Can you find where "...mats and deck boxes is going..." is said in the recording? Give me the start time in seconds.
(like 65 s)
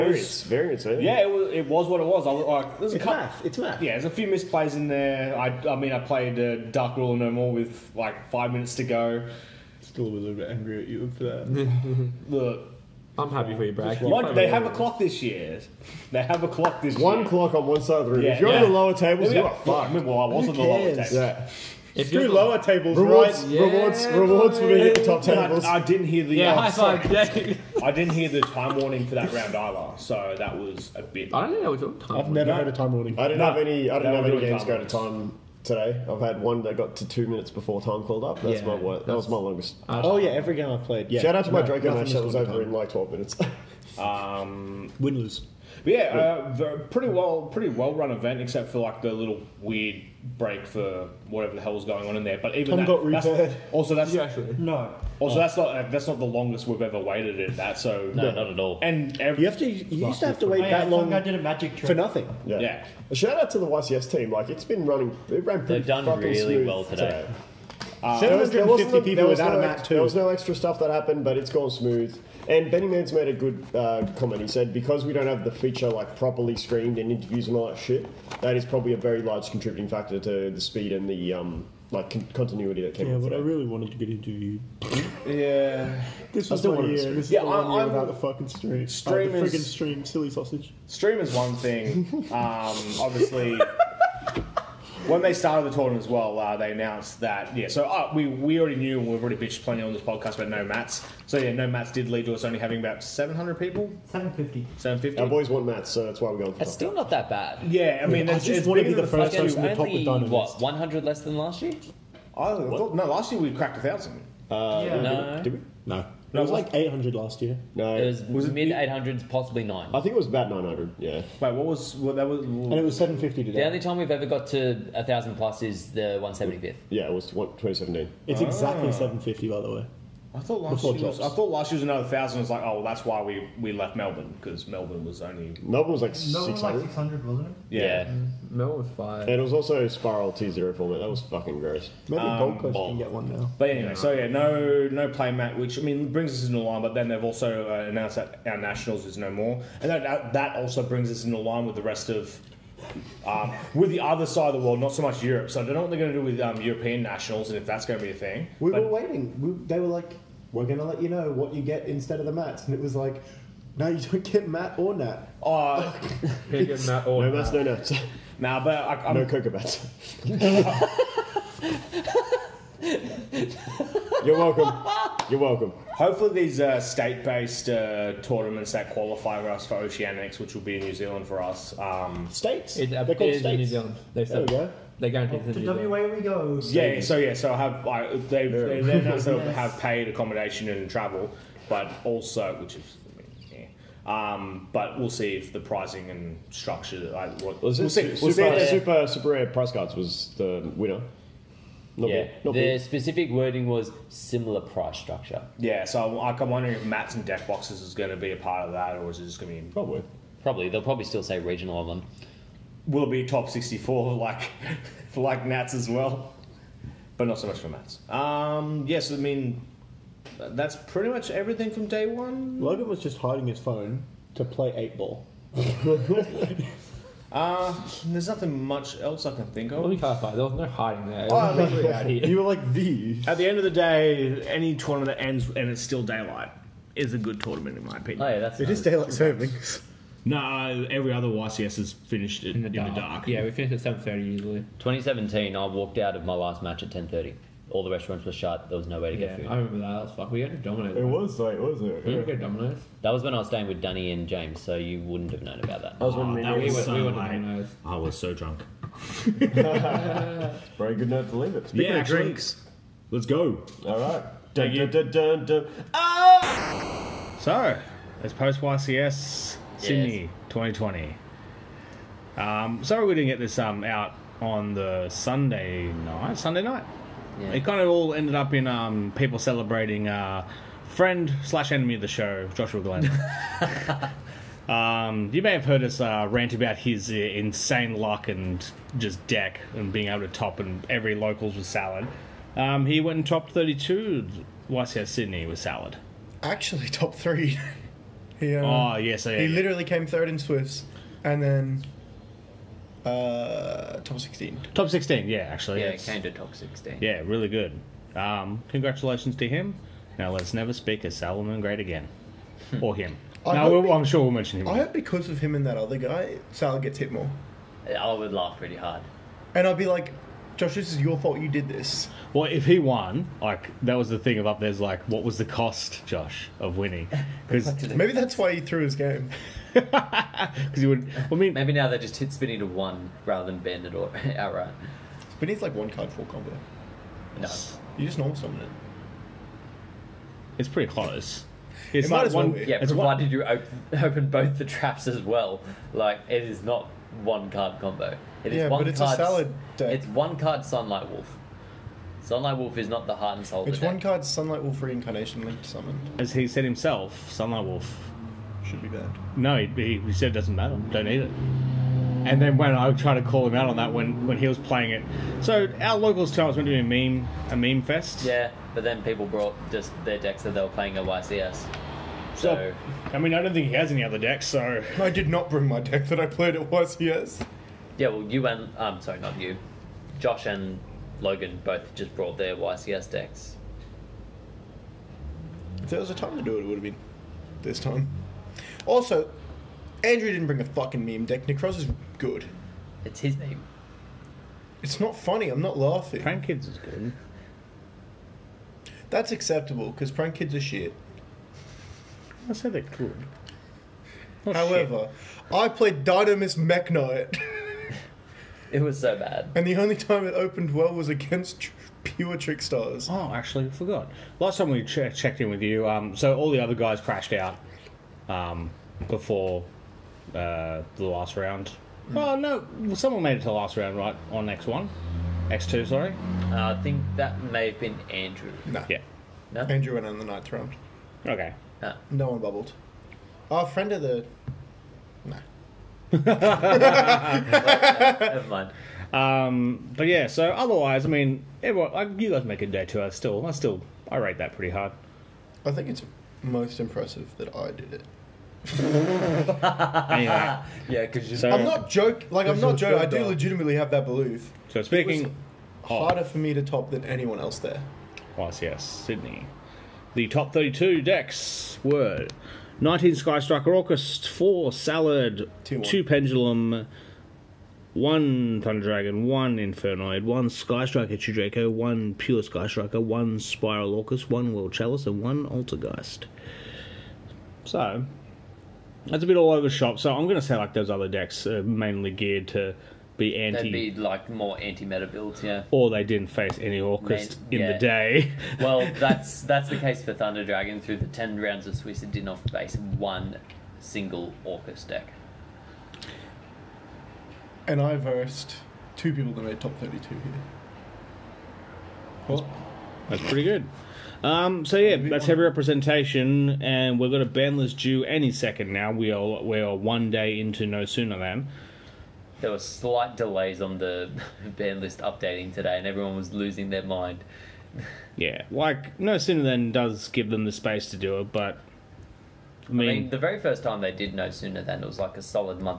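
206 s.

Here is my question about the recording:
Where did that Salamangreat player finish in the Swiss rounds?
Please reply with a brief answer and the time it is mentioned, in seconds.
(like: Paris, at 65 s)
Third, at 299 s.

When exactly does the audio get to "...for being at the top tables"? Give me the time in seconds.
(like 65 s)
24 s.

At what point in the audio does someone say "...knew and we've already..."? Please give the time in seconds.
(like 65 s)
98 s.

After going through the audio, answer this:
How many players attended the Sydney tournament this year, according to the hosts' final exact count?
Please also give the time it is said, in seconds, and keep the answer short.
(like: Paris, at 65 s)
750, at 128 s.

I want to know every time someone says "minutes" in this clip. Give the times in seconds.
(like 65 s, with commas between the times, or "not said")
8 s, 37 s, 43 s.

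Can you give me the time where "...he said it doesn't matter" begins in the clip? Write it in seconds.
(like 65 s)
360 s.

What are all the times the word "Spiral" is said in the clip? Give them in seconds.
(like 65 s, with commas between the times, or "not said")
139 s, 473 s.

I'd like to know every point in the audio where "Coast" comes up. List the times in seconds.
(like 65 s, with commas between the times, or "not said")
142 s.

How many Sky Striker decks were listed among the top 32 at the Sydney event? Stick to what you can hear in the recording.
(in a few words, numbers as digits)
19.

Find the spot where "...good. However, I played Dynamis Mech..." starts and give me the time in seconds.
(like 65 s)
402 s.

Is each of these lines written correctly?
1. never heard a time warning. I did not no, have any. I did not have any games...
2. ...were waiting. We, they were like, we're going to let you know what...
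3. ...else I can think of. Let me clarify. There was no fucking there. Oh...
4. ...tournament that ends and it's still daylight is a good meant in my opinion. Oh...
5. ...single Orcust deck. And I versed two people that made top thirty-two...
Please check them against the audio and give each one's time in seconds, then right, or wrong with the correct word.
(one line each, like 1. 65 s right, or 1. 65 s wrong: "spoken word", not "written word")
1. 32 s right
2. 158 s right
3. 228 s wrong: "hiding", not "fucking"
4. 234 s wrong: "tournament", not "meant"
5. 493 s right.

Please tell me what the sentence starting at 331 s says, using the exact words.
Well, I mean, maybe now they just hit Spinny to one rather than bend it or outright.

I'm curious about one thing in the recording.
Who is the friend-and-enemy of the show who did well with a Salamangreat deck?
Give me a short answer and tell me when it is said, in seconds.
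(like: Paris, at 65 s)
Joshua Glenn, at 282 s.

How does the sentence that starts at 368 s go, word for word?
Yeah, but then people brought just their decks that they were playing at YCS.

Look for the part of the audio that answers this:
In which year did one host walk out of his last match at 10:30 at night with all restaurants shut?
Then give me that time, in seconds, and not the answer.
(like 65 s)
244 s.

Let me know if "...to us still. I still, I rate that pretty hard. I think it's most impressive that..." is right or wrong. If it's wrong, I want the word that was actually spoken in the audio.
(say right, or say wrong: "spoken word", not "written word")
right.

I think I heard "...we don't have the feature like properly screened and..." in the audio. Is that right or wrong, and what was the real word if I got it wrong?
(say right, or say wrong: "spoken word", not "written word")
right.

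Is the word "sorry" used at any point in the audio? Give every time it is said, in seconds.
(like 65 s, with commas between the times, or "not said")
272 s, 378 s, 425 s.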